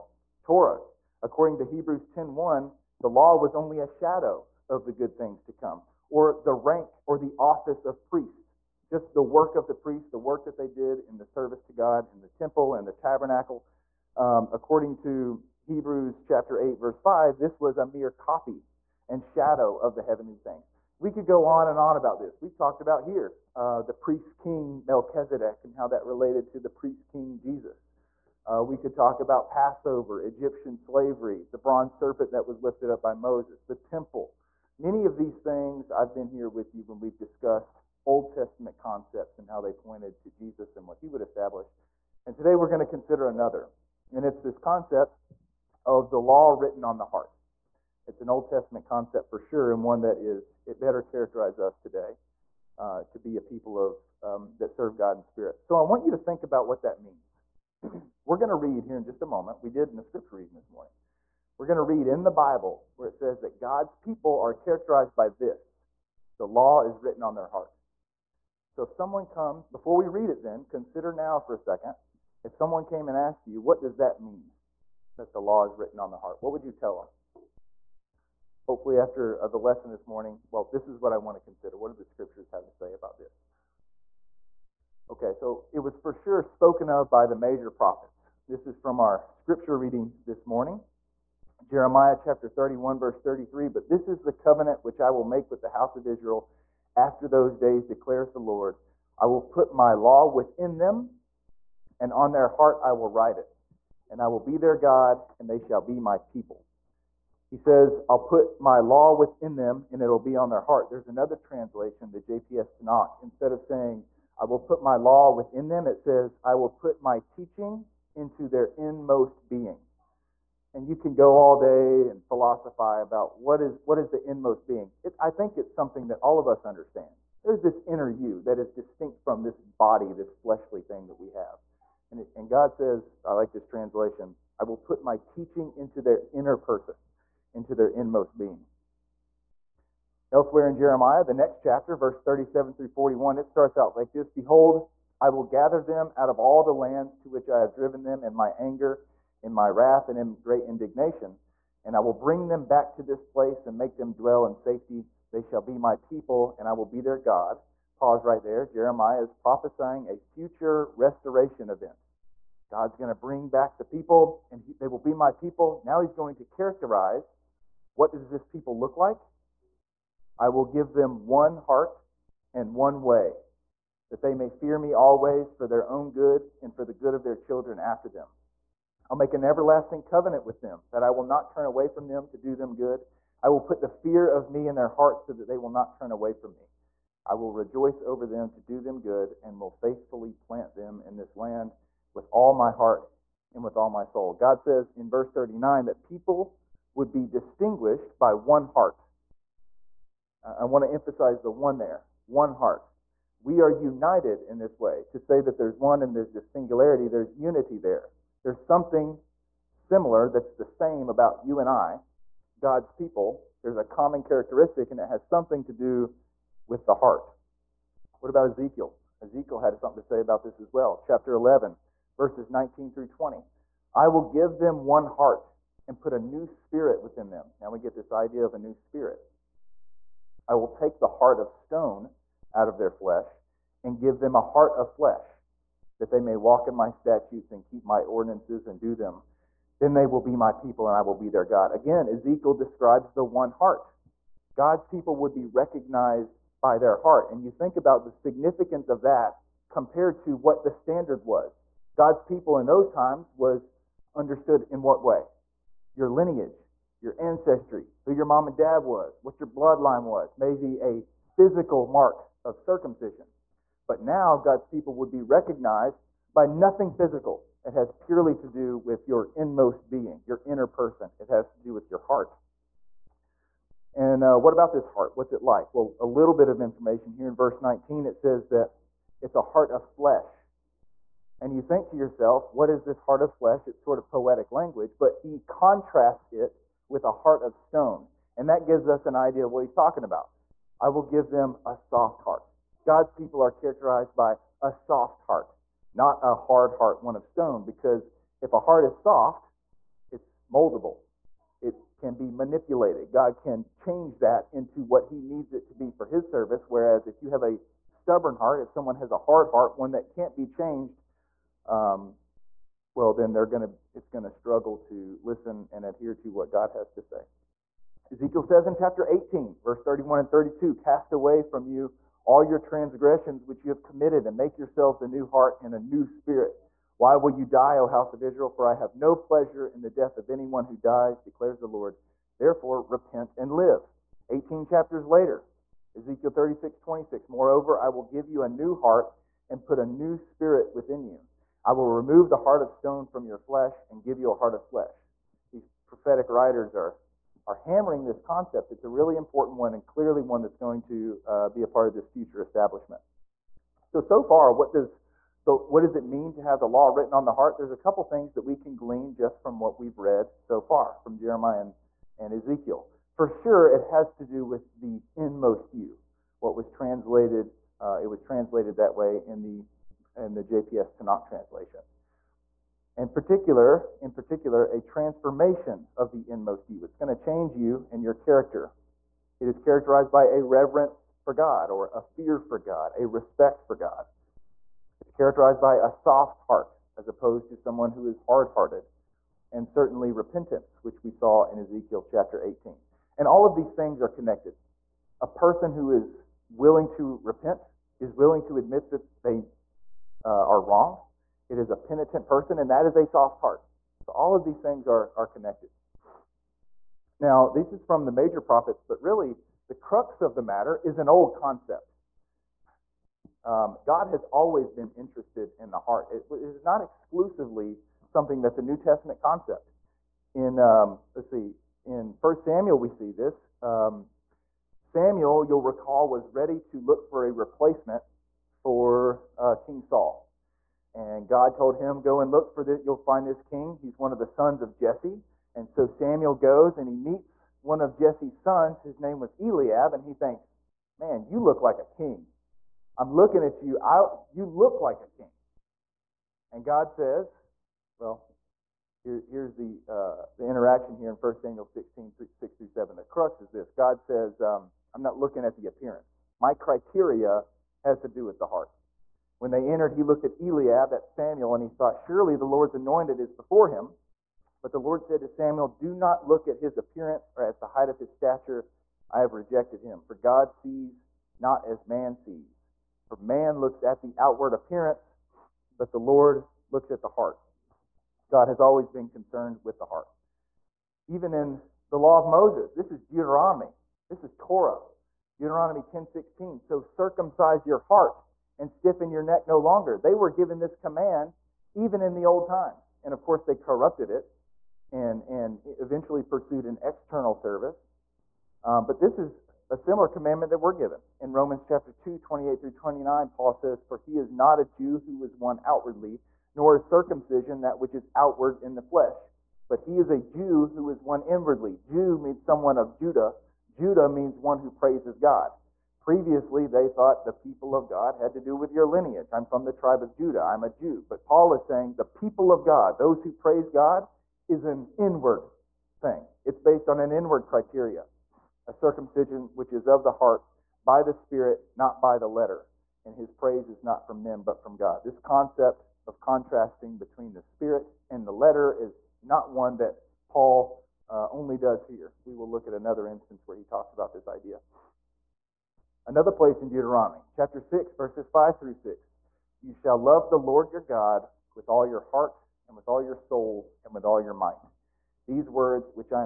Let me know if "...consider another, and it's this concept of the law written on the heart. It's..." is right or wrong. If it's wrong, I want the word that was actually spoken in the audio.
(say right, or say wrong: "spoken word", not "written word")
right.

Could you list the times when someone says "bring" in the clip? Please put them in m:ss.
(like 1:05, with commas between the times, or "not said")
2:32, 2:43.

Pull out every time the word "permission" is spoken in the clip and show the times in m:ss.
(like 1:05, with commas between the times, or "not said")
not said.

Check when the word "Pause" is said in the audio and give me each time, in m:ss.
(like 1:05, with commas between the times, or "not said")
2:37.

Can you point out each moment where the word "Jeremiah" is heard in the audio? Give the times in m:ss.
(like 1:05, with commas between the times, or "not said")
1:31, 2:20, 2:38, 6:01.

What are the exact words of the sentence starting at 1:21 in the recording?
What do the scriptures have to say about this?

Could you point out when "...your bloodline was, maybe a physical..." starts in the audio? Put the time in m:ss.
4:19.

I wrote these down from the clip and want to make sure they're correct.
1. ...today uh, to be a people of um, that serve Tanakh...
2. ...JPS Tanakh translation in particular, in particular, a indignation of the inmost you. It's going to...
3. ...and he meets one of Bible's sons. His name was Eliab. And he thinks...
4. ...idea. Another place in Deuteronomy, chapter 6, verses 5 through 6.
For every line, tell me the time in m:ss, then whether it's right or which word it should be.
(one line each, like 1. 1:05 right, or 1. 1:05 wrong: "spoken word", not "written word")
1. 0:51 wrong: "God", not "Tanakh"
2. 6:10 wrong: "transformation", not "indignation"
3. 7:16 wrong: "Jesse", not "Bible"
4. 9:04 right.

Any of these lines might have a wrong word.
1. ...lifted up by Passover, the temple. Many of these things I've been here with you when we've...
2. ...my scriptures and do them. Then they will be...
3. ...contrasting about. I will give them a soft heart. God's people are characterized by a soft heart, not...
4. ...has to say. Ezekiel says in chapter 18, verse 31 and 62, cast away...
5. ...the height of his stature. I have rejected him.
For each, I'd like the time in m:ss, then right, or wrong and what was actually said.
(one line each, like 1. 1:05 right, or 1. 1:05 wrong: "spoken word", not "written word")
1. 0:32 wrong: "Moses", not "Passover"
2. 3:57 wrong: "ordinances", not "scriptures"
3. 4:49 wrong: "talking", not "contrasting"
4. 5:16 wrong: "32", not "62"
5. 7:47 right.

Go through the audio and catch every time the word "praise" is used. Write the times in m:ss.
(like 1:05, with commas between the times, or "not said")
8:34, 8:43, 8:53.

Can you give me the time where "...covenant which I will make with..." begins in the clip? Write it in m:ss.
1:34.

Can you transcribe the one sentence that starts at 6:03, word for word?
For sure, it has to do with the inmost you.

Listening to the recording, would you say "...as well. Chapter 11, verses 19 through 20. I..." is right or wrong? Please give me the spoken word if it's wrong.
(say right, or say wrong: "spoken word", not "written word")
right.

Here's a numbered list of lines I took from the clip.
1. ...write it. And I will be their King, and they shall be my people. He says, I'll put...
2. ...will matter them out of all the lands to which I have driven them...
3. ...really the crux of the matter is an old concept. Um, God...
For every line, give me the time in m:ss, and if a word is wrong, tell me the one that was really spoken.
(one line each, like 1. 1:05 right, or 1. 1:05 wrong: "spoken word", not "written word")
1. 1:43 wrong: "God", not "King"
2. 2:25 wrong: "gather", not "matter"
3. 6:49 right.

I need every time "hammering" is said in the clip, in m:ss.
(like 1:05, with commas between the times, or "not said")
5:47.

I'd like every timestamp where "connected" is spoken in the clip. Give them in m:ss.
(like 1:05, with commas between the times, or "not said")
6:34, 6:45.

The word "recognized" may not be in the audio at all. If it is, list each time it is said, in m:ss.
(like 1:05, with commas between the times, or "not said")
4:05, 4:25.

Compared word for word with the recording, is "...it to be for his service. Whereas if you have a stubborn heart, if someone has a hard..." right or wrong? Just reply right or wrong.
right.